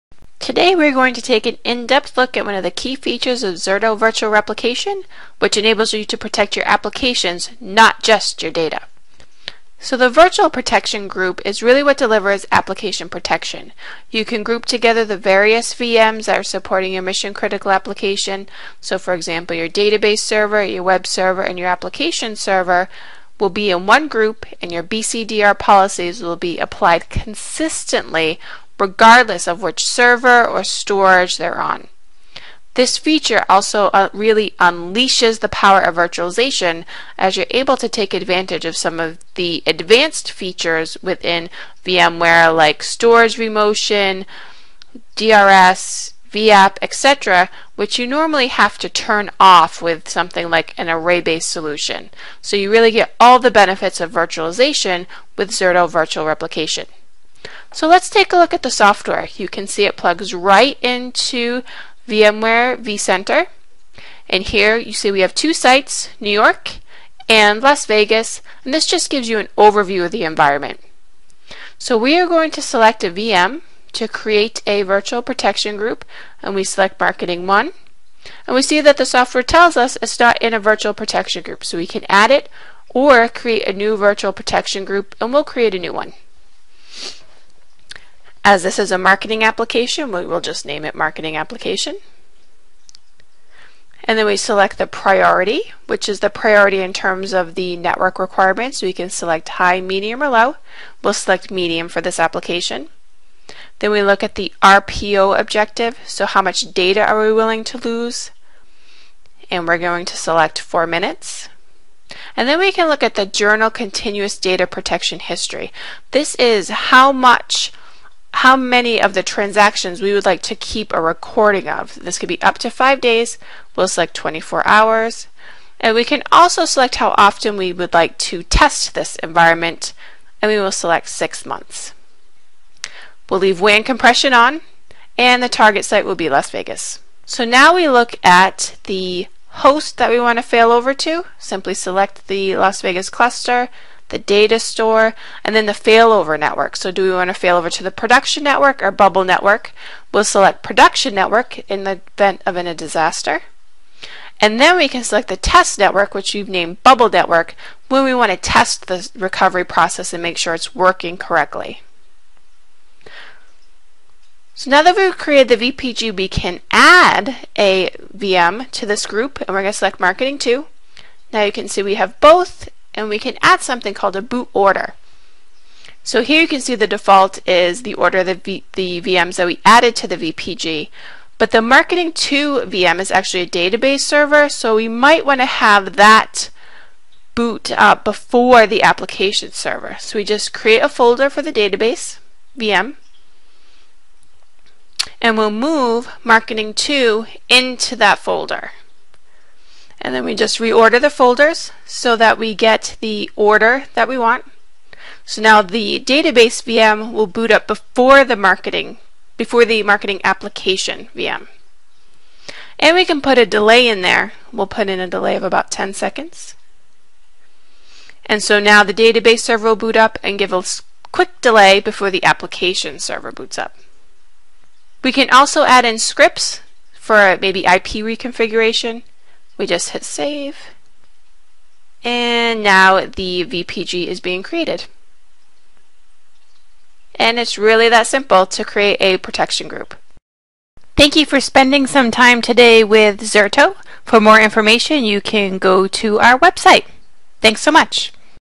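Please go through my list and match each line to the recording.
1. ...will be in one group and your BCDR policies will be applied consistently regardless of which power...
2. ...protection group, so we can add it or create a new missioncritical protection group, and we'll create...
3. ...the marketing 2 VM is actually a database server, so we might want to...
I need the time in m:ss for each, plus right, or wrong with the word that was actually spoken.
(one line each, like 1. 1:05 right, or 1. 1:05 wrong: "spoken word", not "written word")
1. 0:23 wrong: "server", not "power"
2. 1:20 wrong: "virtual", not "missioncritical"
3. 3:01 right.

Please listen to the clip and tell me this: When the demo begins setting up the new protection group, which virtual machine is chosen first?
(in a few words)
Marketing 1.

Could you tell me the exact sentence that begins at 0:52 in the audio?
So you really get all the benefits of virtualization with Zerto Virtual Replication.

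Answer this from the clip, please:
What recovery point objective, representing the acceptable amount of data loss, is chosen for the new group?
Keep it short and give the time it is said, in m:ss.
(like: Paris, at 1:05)
4 minutes, at 1:50.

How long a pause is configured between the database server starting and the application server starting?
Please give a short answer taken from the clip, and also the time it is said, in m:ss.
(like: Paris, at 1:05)
10 seconds, at 3:35.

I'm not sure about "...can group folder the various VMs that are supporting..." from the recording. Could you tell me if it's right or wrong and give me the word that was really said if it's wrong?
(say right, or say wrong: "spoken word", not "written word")
wrong: "together", not "folder".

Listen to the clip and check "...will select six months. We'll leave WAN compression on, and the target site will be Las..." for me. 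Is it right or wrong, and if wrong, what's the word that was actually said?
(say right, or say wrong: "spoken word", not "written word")
right.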